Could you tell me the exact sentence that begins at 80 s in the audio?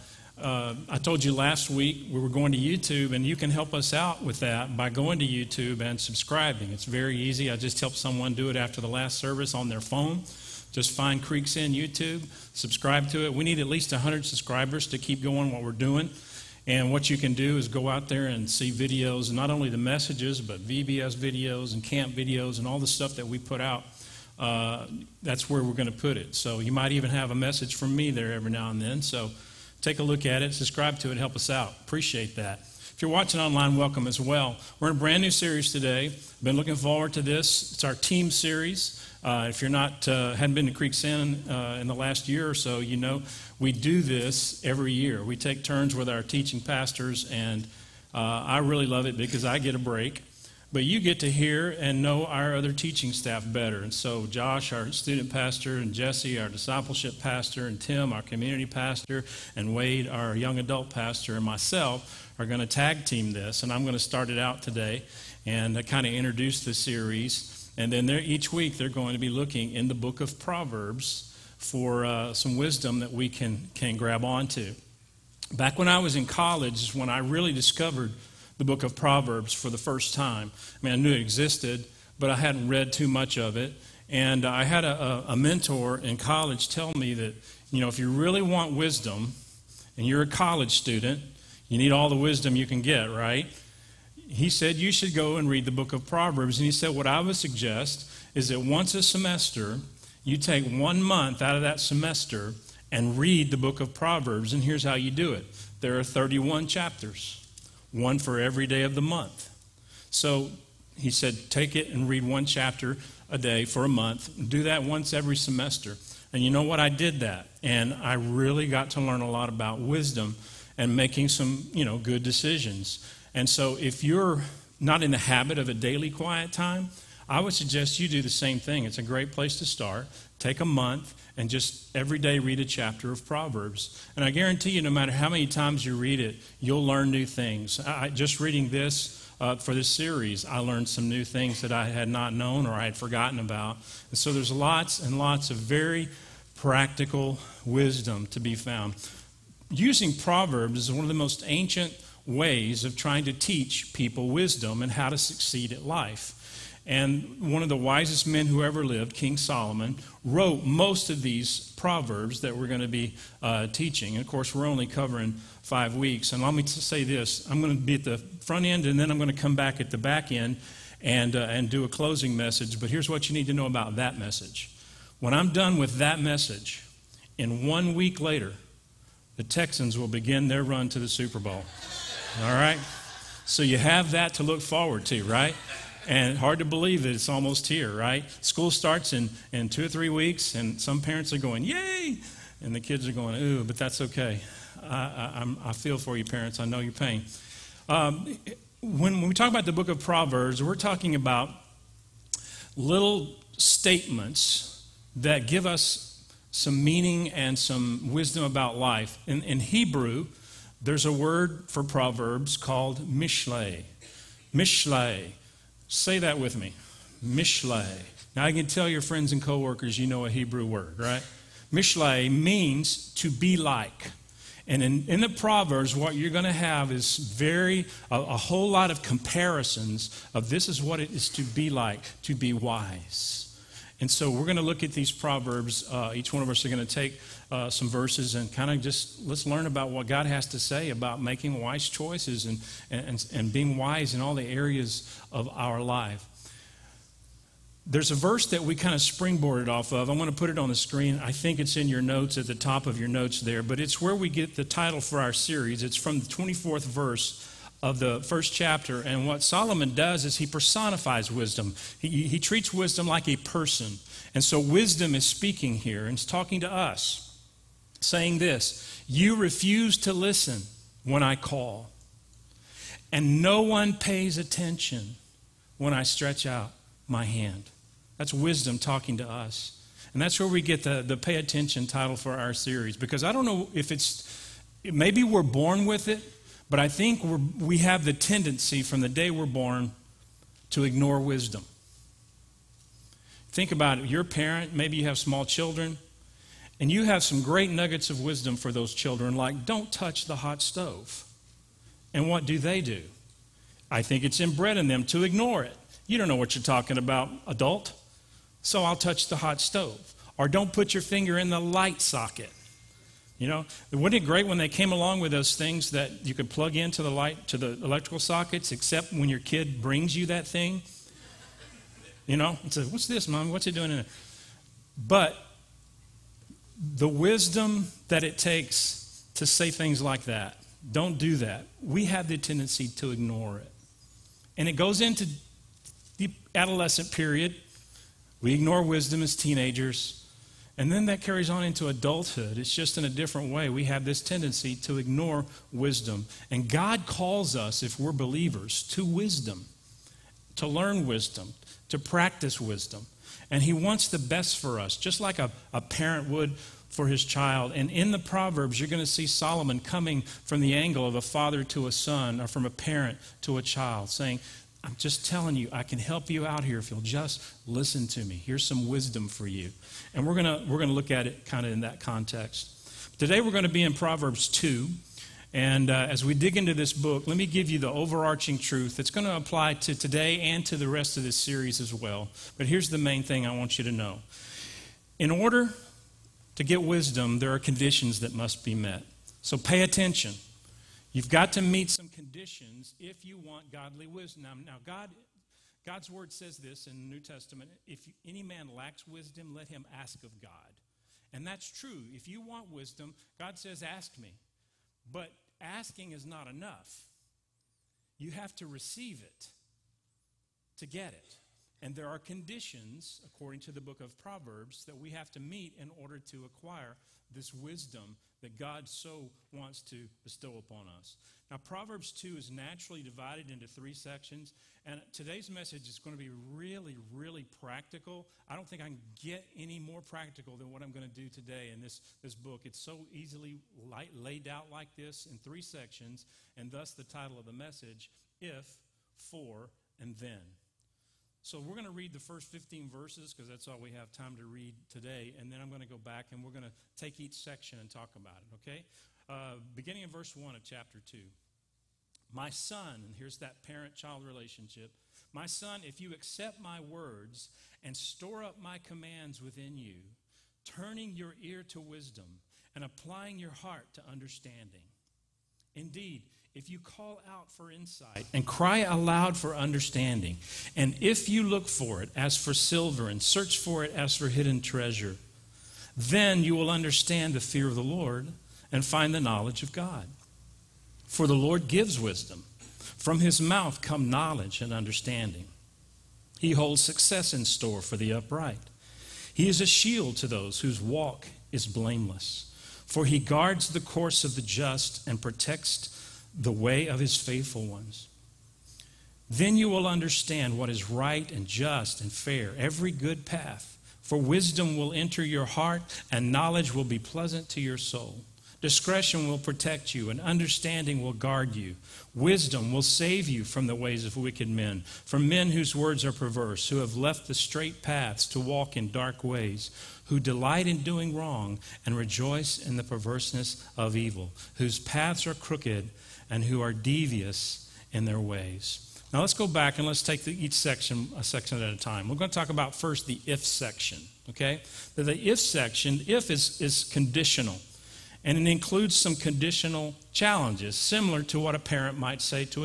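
I mean, I knew it existed, but I hadn't read too much of it.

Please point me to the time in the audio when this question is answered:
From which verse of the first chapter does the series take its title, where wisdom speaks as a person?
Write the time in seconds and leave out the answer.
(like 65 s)
256 s.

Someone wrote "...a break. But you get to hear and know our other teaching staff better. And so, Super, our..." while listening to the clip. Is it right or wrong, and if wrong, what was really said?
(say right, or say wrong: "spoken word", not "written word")
wrong: "Josh", not "Super".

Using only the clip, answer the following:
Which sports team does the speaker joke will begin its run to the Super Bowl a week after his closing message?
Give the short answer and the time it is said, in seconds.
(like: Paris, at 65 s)
Texans, at 179 s.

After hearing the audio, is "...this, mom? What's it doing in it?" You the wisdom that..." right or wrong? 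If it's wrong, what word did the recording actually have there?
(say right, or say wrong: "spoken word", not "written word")
wrong: "But", not "You".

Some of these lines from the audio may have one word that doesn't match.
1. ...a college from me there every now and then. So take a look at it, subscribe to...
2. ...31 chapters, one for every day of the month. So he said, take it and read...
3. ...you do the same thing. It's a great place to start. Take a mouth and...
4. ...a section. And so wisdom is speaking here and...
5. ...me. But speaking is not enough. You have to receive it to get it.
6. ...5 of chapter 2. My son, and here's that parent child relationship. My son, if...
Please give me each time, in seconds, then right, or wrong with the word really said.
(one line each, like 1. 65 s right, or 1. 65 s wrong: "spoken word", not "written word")
1. 27 s wrong: "message", not "college"
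2. 106 s right
3. 127 s wrong: "month", not "mouth"
4. 263 s wrong: "person", not "section"
5. 404 s wrong: "asking", not "speaking"
6. 450 s wrong: "1", not "5".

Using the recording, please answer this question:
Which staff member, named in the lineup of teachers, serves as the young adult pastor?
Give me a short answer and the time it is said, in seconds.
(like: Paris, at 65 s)
Wade, at 59 s.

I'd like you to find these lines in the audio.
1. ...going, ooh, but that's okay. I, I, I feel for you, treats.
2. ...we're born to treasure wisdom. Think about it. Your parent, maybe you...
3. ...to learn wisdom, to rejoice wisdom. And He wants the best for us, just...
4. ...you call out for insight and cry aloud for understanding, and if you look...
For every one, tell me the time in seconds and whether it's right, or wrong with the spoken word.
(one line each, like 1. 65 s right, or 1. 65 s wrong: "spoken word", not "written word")
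1. 193 s wrong: "parents", not "treats"
2. 289 s wrong: "ignore", not "treasure"
3. 350 s wrong: "practice", not "rejoice"
4. 466 s right.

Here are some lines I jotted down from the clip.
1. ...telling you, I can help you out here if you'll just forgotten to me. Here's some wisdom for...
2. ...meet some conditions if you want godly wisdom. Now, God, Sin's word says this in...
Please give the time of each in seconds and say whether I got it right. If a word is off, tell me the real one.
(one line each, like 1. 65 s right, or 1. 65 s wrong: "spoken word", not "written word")
1. 365 s wrong: "listen", not "forgotten"
2. 391 s wrong: "God", not "Sin".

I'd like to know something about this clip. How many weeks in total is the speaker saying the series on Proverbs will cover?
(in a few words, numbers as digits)
5.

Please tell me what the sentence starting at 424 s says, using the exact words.
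And today's message is going to be really, really practical.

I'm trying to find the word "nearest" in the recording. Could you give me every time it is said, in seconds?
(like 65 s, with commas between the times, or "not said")
not said.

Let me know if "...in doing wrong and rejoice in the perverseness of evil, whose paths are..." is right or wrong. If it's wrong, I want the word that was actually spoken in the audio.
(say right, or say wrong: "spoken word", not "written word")
right.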